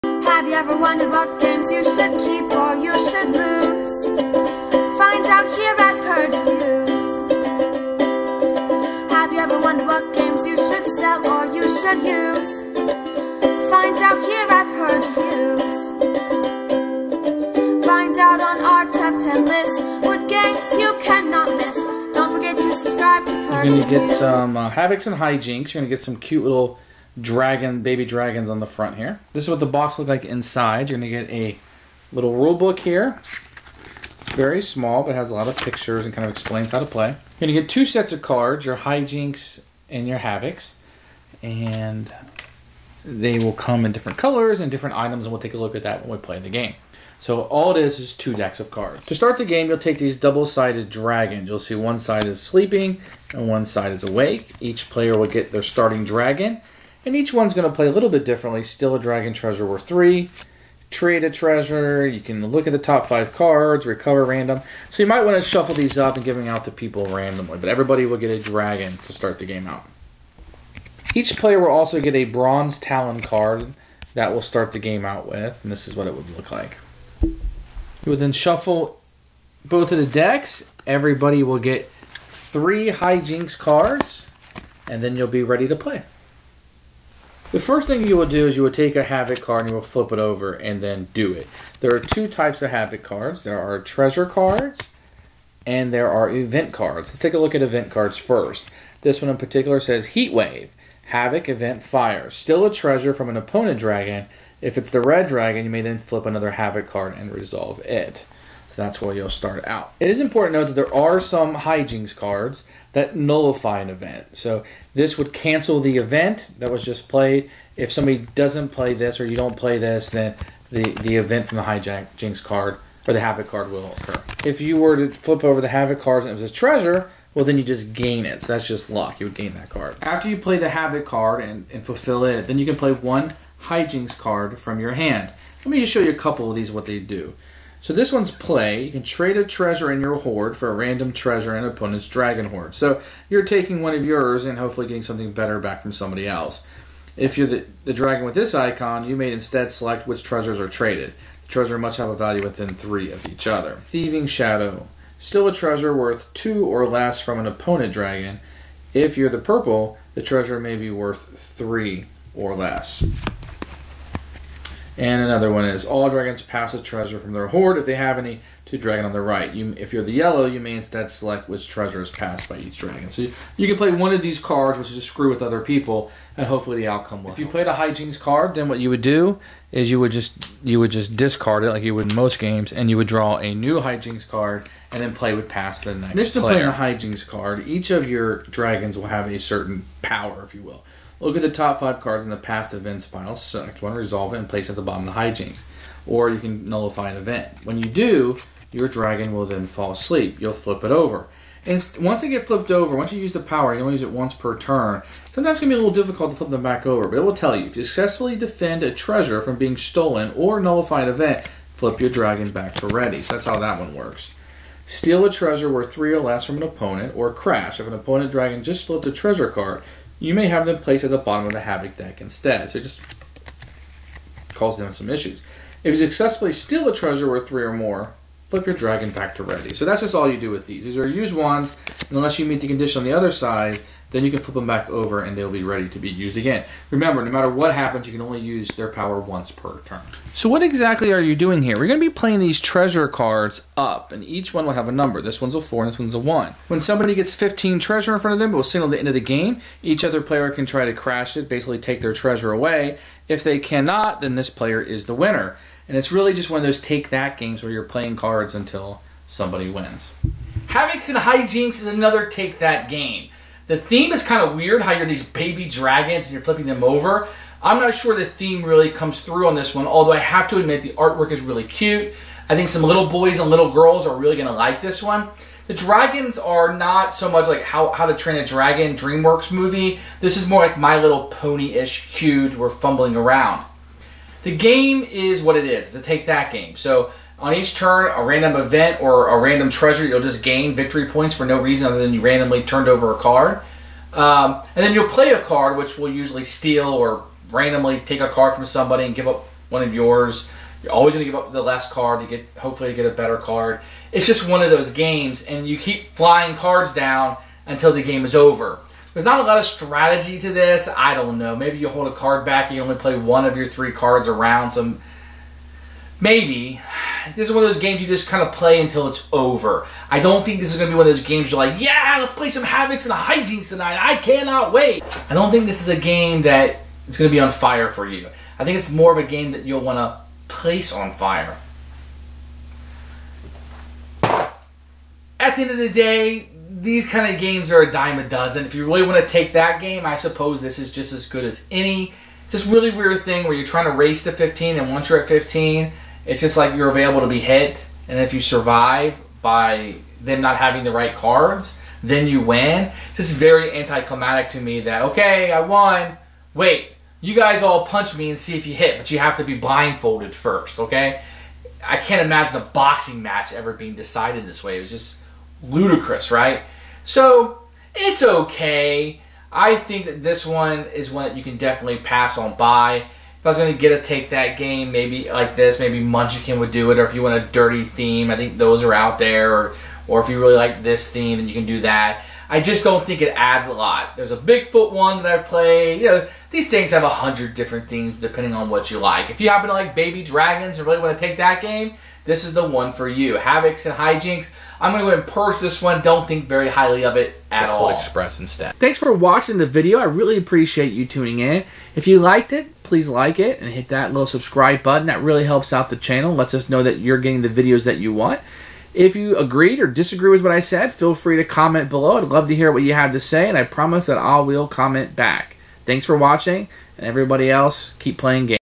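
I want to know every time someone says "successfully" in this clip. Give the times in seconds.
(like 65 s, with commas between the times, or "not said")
207 s, 226 s.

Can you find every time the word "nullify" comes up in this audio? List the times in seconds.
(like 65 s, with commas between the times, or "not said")
113 s, 196 s, 210 s.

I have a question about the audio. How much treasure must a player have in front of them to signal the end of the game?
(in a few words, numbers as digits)
15.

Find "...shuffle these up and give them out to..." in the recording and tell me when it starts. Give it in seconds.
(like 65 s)
65 s.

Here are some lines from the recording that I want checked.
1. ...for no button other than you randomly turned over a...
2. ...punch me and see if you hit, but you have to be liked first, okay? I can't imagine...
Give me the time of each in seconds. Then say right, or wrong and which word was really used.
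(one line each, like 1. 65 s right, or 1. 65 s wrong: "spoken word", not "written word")
1. 291 s wrong: "reason", not "button"
2. 357 s wrong: "blindfolded", not "liked".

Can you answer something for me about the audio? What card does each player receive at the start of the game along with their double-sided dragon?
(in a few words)
Bronze Talon.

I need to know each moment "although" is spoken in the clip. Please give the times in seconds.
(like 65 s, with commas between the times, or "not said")
269 s.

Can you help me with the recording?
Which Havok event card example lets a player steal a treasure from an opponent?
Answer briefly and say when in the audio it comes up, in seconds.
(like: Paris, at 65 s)
Heat Wave, at 100 s.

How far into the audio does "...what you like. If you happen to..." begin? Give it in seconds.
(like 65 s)
388 s.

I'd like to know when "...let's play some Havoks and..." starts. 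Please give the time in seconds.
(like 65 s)
322 s.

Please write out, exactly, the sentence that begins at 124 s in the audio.
If you were to flip over the Havok cards and it was a treasure, well then you just gain it.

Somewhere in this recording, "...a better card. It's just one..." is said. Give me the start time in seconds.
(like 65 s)
303 s.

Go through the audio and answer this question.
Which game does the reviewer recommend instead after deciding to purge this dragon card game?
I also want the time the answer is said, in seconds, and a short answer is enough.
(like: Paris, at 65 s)
Colt Express, at 397 s.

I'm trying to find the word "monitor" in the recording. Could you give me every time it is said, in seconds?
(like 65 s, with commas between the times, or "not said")
not said.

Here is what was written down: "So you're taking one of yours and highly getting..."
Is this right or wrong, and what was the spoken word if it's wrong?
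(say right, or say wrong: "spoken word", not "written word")
wrong: "hopefully", not "highly".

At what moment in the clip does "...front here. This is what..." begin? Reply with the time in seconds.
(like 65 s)
28 s.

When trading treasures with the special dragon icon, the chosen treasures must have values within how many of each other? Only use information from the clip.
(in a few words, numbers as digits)
3.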